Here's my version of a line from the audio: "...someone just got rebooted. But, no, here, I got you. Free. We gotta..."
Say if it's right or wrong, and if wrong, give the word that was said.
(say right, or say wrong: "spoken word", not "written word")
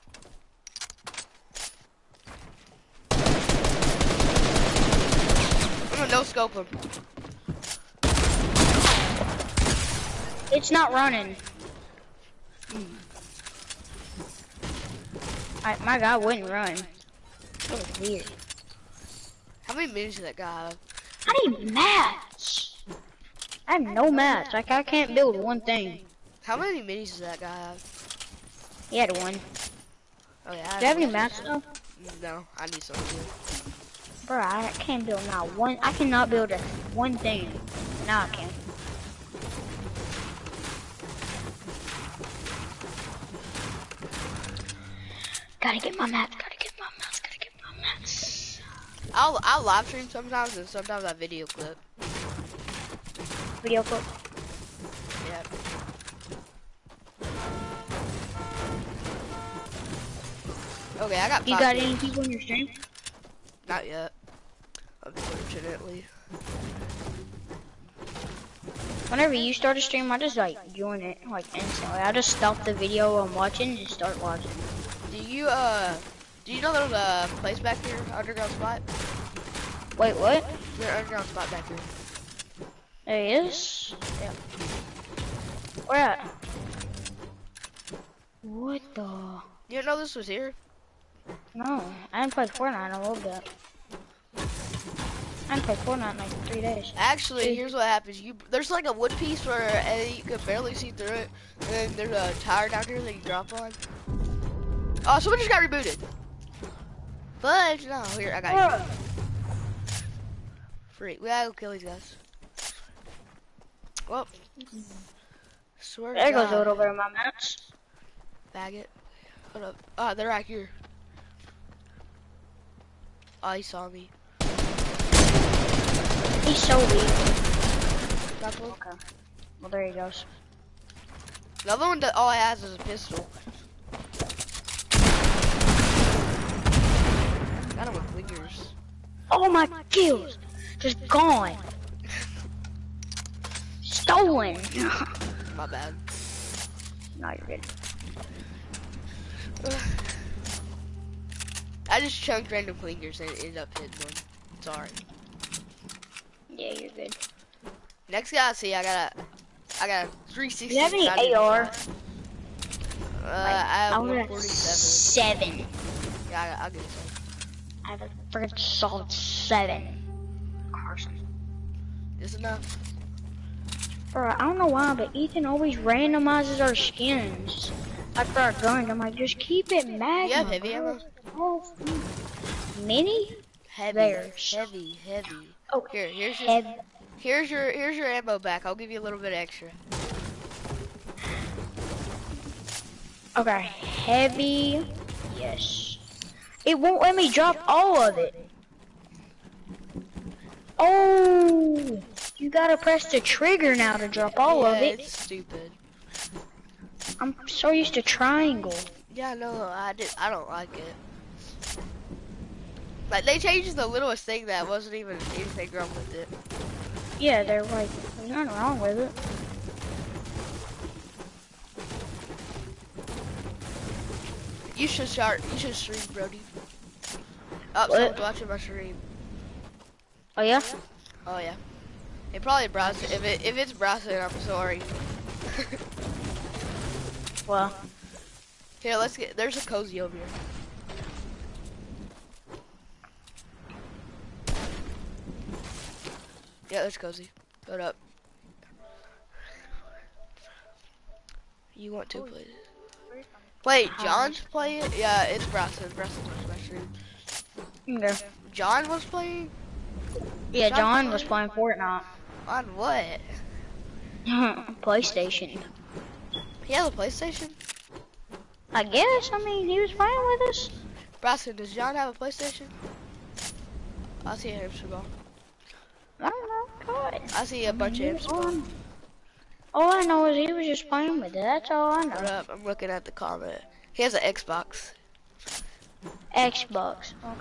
right.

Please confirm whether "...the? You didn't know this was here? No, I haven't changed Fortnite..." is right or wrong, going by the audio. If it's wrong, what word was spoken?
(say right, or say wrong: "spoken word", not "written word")
wrong: "played", not "changed".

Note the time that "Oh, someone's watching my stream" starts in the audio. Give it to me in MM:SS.
03:47.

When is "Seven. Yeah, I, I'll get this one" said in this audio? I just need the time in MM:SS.
02:44.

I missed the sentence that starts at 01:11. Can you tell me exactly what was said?
I just stop the video I'm watching and start watching.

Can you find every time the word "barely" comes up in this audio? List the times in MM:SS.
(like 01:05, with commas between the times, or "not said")
01:40.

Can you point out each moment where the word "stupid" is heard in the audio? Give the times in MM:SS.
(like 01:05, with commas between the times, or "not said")
03:25.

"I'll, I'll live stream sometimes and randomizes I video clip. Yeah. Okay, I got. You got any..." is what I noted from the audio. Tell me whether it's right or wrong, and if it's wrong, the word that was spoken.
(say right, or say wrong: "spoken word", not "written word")
wrong: "sometimes", not "randomizes".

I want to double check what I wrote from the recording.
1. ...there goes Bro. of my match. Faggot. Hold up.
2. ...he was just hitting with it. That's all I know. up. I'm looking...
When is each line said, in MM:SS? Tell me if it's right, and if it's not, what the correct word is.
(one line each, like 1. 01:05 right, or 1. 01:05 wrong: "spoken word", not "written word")
1. 01:56 wrong: "God", not "Bro"
2. 04:40 wrong: "playing", not "hitting".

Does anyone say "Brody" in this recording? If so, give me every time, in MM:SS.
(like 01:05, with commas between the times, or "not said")
03:46.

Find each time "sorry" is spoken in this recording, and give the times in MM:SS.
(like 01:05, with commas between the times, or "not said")
02:34, 03:54.